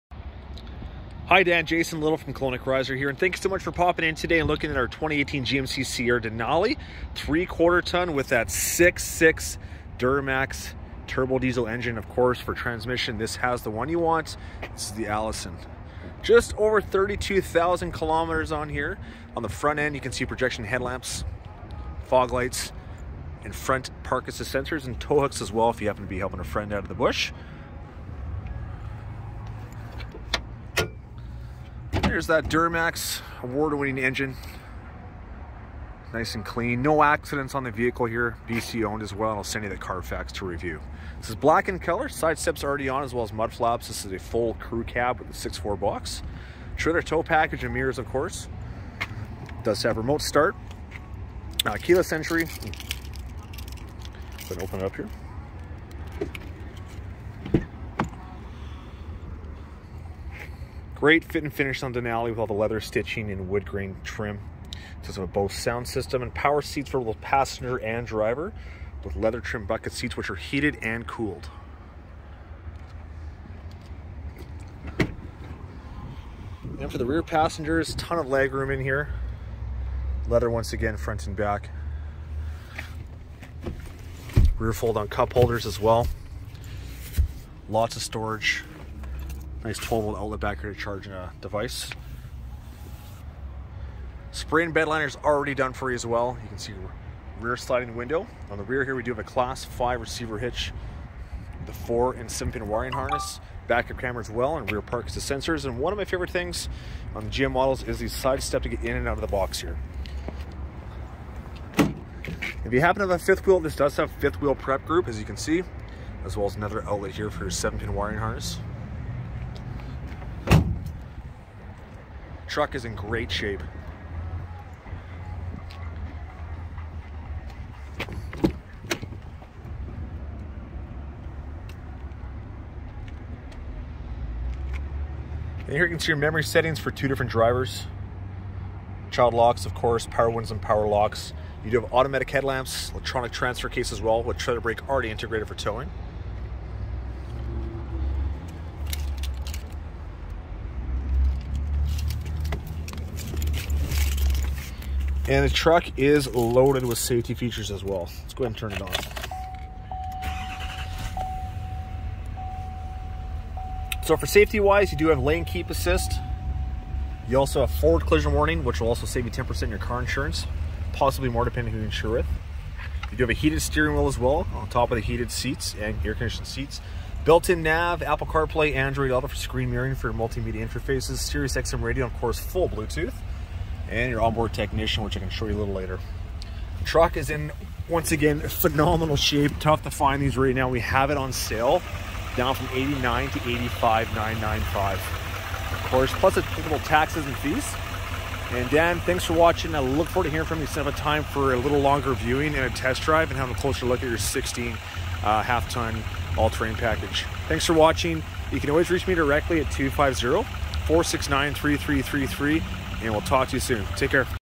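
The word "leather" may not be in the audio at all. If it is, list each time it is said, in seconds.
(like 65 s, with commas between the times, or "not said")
62 s, 69 s, 80 s.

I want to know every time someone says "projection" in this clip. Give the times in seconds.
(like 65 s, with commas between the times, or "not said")
20 s.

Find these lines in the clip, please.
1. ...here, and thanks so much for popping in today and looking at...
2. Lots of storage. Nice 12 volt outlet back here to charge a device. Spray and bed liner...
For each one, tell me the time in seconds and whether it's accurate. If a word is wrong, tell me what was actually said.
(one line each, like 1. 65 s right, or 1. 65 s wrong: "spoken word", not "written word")
1. 2 s right
2. 87 s right.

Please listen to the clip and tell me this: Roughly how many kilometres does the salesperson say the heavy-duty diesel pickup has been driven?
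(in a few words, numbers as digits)
32,000 kilometers.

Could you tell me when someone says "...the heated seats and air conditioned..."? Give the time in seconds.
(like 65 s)
174 s.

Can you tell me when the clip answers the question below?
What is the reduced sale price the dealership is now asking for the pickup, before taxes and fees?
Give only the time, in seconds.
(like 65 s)
193 s.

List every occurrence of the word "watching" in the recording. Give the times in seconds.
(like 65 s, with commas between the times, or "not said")
199 s, 207 s.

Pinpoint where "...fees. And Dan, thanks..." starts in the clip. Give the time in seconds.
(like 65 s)
197 s.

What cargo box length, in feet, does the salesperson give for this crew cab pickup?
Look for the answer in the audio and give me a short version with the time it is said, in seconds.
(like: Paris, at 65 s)
6.4, at 45 s.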